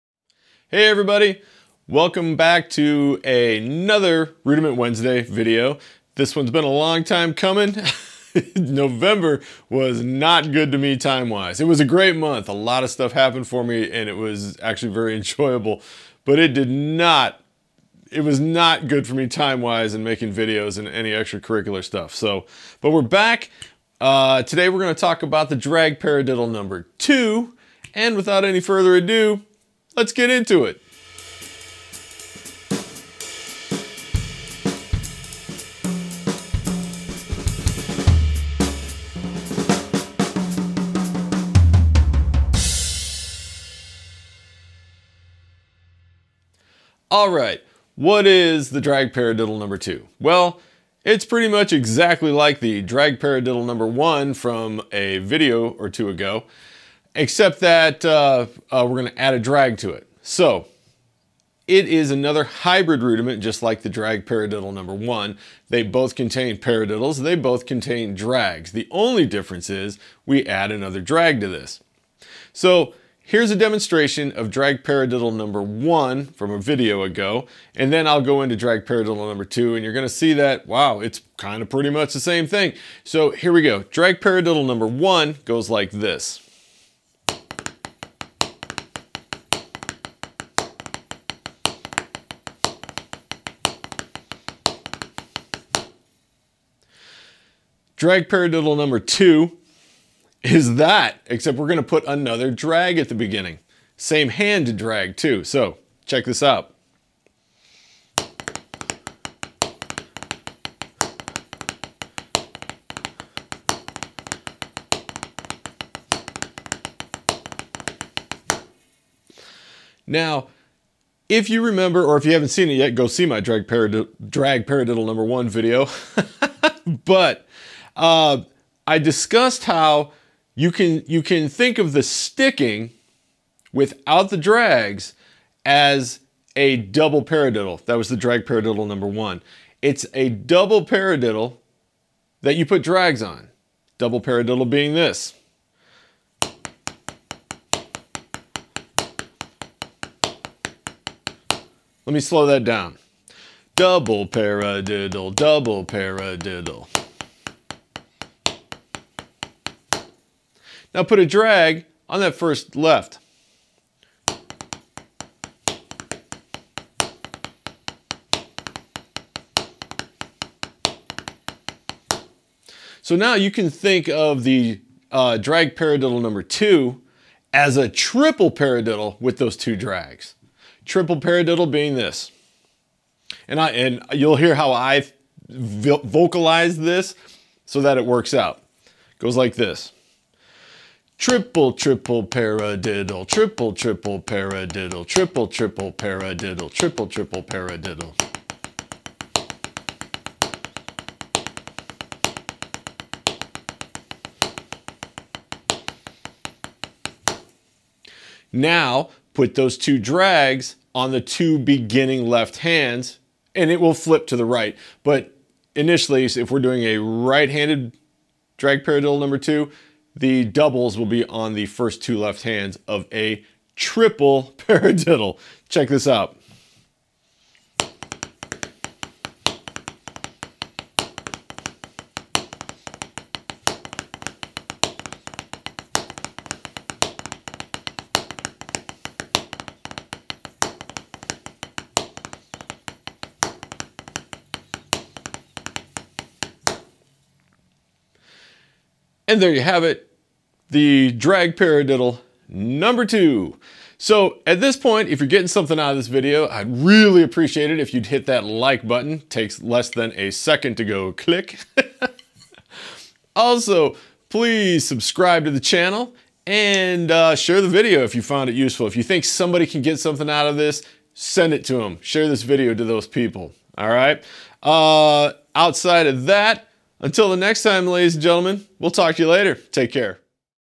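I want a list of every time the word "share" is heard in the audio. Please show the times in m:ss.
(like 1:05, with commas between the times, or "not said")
4:27, 4:32.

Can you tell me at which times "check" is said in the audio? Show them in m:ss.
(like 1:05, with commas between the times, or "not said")
1:46, 3:45.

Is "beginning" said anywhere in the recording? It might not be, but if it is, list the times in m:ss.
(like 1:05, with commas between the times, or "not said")
1:43, 3:31.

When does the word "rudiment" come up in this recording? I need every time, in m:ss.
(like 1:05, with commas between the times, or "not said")
0:04, 1:03.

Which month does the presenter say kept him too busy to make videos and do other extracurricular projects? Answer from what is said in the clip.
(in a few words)
November.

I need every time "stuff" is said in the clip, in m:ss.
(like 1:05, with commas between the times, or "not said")
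0:12, 0:21.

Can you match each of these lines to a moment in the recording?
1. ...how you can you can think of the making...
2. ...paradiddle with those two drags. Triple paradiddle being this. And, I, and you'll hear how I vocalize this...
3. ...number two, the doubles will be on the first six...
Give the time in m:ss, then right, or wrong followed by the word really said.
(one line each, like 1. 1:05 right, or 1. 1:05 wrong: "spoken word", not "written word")
1. 2:09 wrong: "sticking", not "making"
2. 2:58 right
3. 3:39 wrong: "two", not "six".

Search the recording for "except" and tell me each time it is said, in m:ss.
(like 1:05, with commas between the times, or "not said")
0:57, 1:41.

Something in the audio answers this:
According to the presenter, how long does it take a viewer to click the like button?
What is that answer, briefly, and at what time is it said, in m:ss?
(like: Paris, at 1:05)
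less than a second, at 4:19.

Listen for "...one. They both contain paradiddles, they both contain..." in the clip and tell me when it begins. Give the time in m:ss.
1:04.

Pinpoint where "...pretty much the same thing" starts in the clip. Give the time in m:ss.
1:21.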